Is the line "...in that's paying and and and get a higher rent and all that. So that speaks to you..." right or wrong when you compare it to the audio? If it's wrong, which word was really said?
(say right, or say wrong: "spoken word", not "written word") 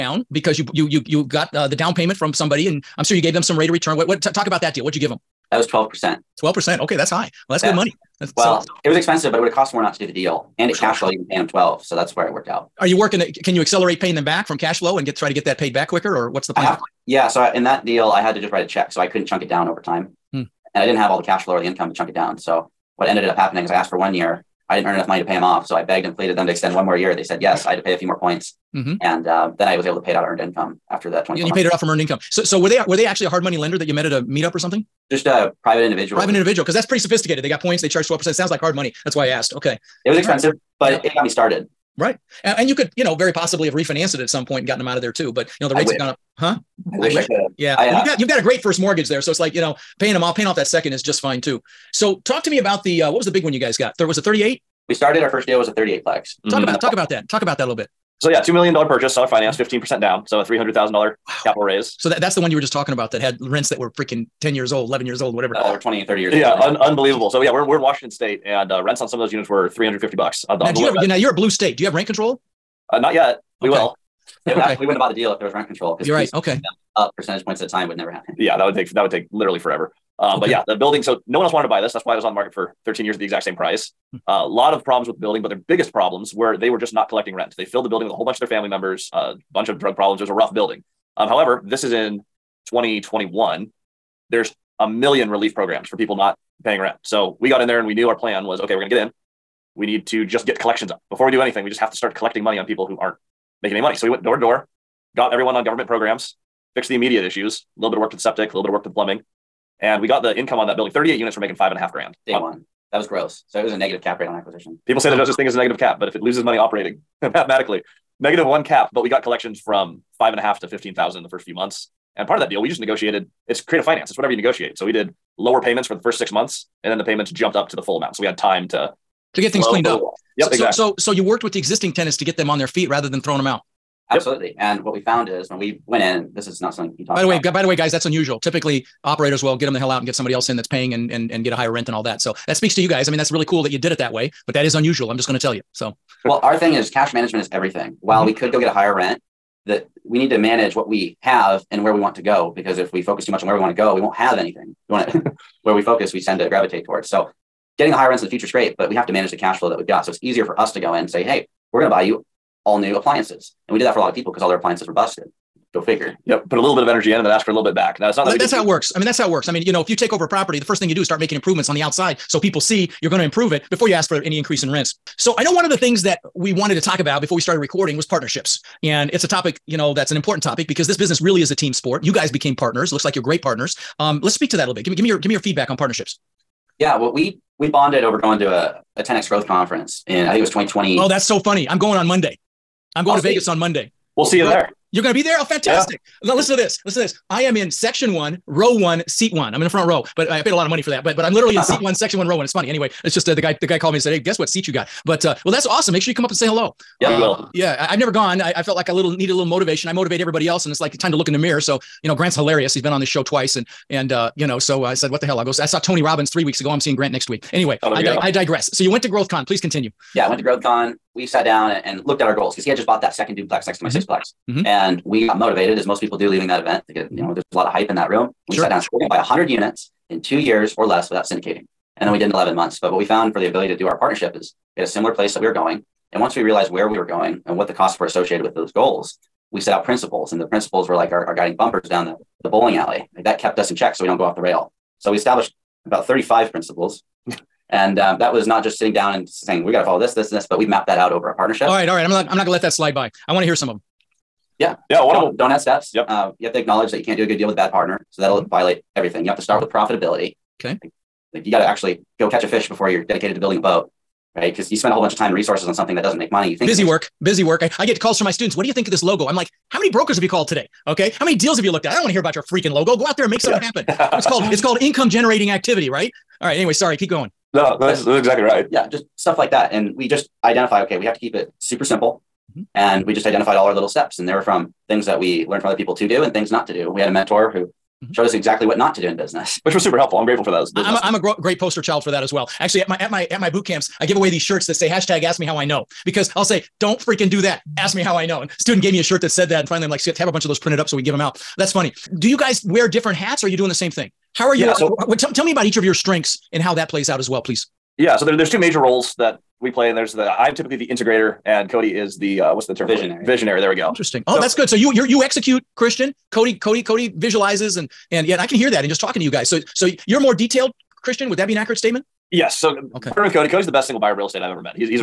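right.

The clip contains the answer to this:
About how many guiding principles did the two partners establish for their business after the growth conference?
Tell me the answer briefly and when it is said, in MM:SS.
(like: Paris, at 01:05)
35, at 04:06.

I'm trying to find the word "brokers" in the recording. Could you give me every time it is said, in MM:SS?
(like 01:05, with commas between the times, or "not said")
04:29.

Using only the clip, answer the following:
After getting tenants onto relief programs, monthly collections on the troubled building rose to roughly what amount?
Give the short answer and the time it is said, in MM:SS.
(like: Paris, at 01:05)
15,000, at 02:00.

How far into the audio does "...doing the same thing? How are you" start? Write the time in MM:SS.
05:03.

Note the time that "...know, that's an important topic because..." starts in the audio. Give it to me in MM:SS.
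02:59.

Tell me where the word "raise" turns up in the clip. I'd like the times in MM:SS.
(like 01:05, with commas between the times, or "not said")
01:01.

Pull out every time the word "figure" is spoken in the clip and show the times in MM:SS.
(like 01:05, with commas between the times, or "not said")
02:45.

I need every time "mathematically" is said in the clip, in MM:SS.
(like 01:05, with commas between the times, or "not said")
01:57.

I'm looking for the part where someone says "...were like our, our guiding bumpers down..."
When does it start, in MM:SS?
04:00.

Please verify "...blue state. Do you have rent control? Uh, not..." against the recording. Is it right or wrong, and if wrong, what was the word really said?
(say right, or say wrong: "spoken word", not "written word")
right.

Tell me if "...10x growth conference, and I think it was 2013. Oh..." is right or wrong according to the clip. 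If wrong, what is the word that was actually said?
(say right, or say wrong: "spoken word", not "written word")
wrong: "2020", not "2013".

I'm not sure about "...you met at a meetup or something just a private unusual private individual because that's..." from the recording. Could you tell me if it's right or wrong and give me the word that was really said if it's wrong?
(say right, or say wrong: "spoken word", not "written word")
wrong: "individual", not "unusual".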